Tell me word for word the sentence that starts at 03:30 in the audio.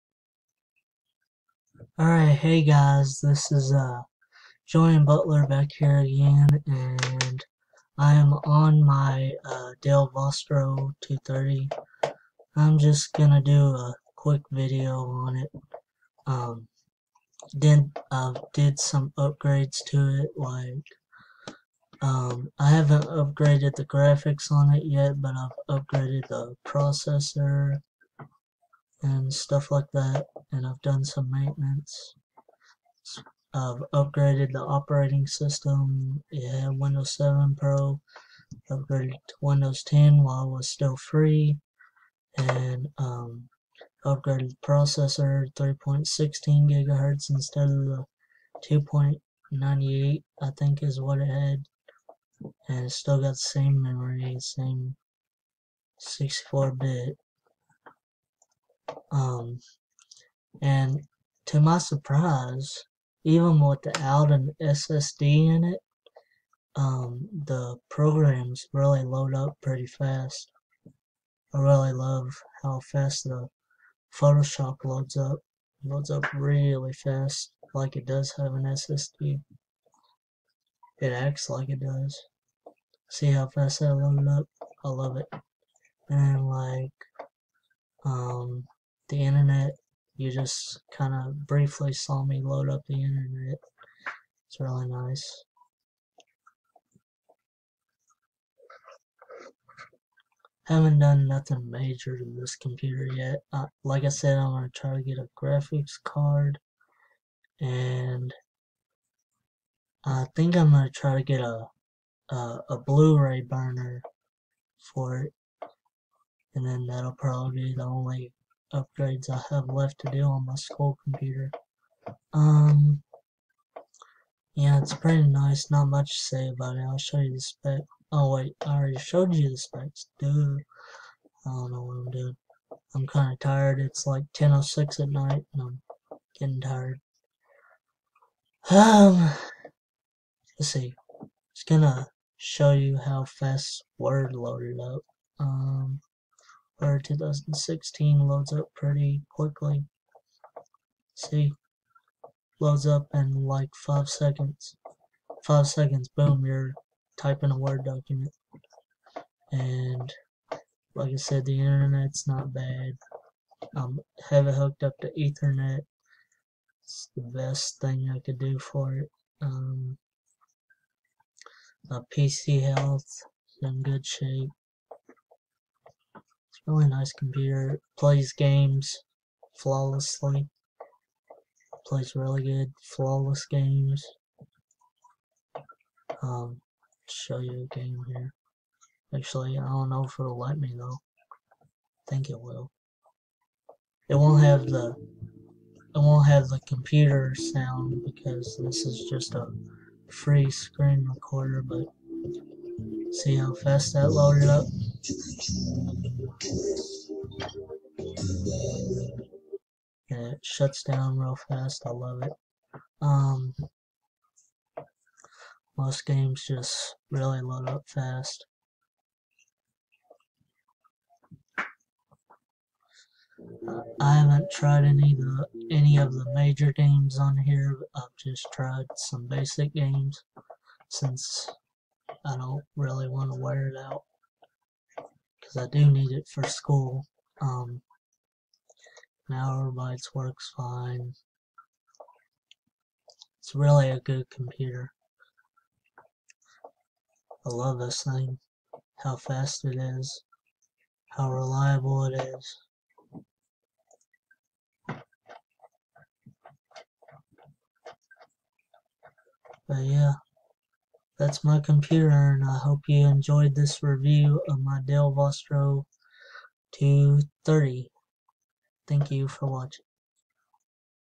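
And it shuts down real fast.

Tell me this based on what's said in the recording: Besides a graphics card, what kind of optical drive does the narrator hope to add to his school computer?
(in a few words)
Blu-ray burner.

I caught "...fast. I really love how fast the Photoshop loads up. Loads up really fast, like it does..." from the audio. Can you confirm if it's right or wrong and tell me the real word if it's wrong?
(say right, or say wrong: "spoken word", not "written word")
right.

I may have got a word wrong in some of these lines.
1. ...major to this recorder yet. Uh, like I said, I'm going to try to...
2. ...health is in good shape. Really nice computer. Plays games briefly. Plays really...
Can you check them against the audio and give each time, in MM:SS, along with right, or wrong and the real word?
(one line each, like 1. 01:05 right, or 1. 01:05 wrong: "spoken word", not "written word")
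1. 01:41 wrong: "computer", not "recorder"
2. 02:52 wrong: "flawlessly", not "briefly".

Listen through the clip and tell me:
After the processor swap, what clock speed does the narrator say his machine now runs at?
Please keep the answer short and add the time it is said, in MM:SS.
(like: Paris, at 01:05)
3.16 gigahertz, at 00:45.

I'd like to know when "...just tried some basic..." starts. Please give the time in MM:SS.
03:48.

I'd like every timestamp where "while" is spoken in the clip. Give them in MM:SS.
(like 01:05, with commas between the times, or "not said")
00:40.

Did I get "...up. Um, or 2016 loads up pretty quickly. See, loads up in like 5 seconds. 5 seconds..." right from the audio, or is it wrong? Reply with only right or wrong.
right.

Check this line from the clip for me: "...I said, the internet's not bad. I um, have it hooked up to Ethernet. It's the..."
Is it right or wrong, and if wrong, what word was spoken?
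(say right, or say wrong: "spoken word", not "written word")
right.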